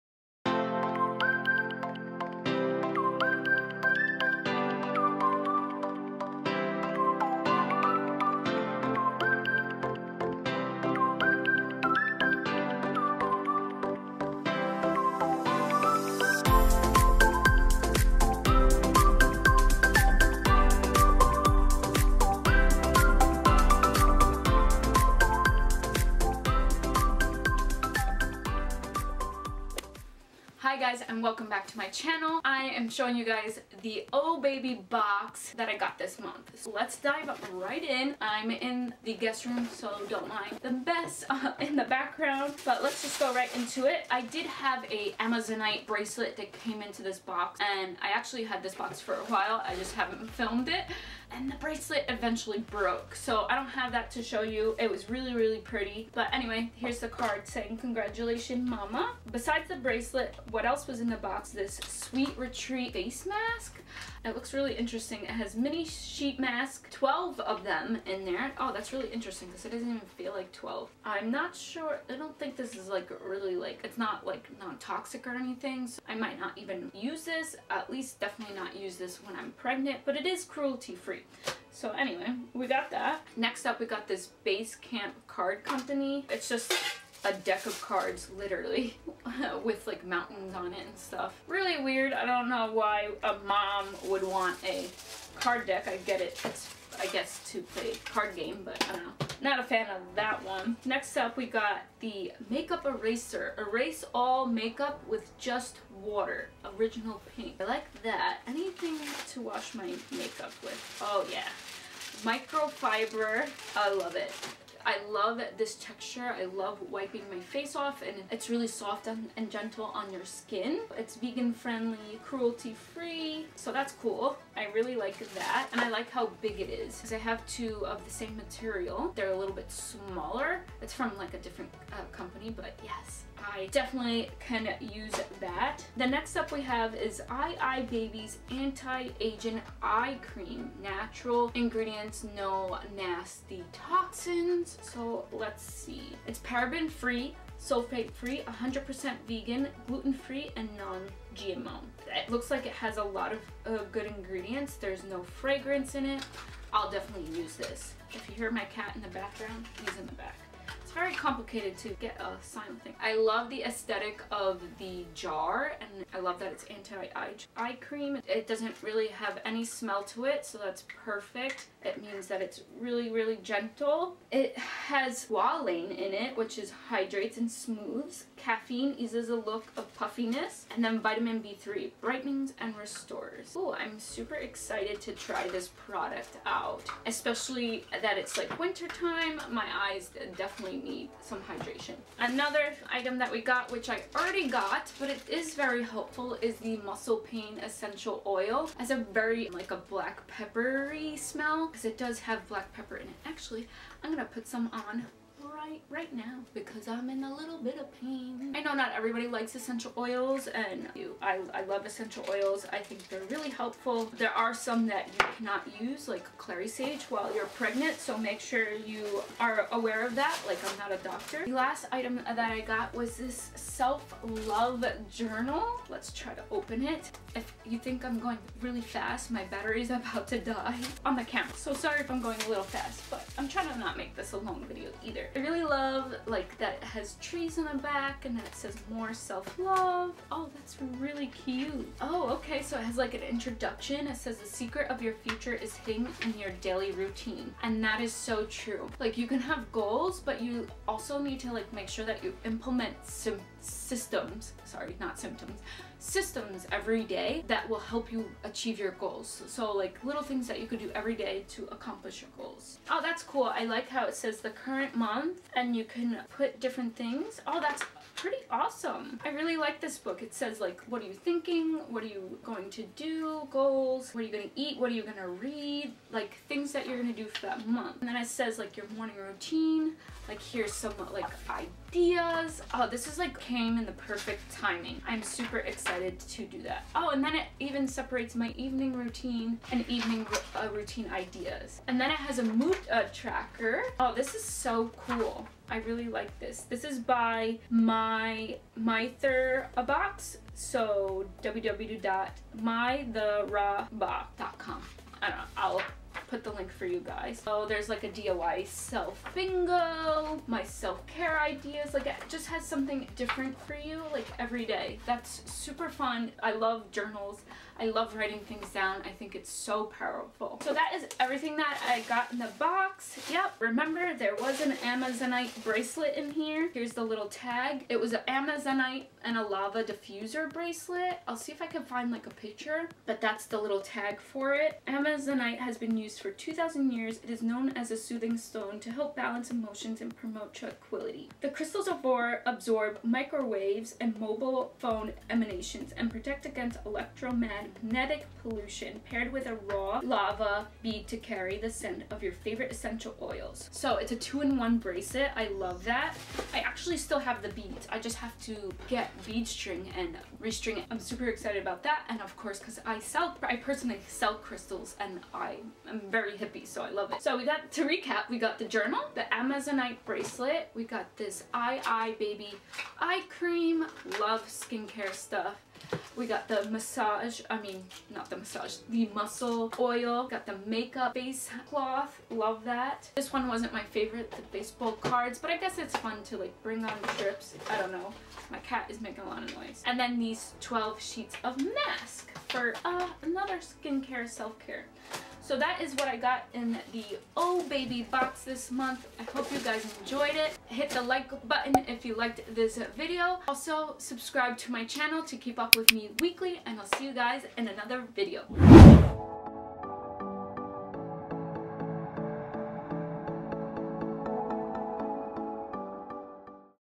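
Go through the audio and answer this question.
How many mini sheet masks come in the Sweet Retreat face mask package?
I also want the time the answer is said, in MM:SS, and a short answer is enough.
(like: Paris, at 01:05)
12, at 01:06.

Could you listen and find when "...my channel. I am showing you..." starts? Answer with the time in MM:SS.
00:31.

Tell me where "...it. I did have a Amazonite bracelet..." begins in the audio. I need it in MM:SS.
00:43.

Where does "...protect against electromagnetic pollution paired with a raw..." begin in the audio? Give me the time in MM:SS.
05:46.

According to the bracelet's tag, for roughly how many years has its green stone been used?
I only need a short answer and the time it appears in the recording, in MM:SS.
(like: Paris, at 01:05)
2,000 years, at 05:36.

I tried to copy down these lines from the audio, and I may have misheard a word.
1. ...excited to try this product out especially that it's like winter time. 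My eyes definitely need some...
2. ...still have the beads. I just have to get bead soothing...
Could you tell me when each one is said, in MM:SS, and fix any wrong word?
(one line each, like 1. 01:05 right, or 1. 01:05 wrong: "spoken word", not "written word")
1. 03:04 right
2. 05:56 wrong: "string", not "soothing".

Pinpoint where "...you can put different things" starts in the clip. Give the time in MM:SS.
04:25.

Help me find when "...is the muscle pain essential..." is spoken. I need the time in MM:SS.
03:16.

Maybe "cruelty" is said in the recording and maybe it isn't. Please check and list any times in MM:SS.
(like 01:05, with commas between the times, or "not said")
01:20, 02:02.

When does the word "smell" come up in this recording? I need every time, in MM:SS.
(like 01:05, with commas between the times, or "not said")
02:49, 03:21.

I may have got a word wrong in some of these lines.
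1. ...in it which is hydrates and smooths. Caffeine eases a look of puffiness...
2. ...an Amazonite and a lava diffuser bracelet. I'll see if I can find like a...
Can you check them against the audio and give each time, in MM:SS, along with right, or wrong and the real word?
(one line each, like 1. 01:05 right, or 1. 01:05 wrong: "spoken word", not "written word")
1. 02:55 right
2. 05:28 right.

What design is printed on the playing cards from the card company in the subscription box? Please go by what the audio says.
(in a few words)
mountains.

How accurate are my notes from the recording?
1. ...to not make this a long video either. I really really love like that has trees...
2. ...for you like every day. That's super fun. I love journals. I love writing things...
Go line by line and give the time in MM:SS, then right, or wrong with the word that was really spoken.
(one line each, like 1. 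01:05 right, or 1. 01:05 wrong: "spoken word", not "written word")
1. 03:53 right
2. 05:13 right.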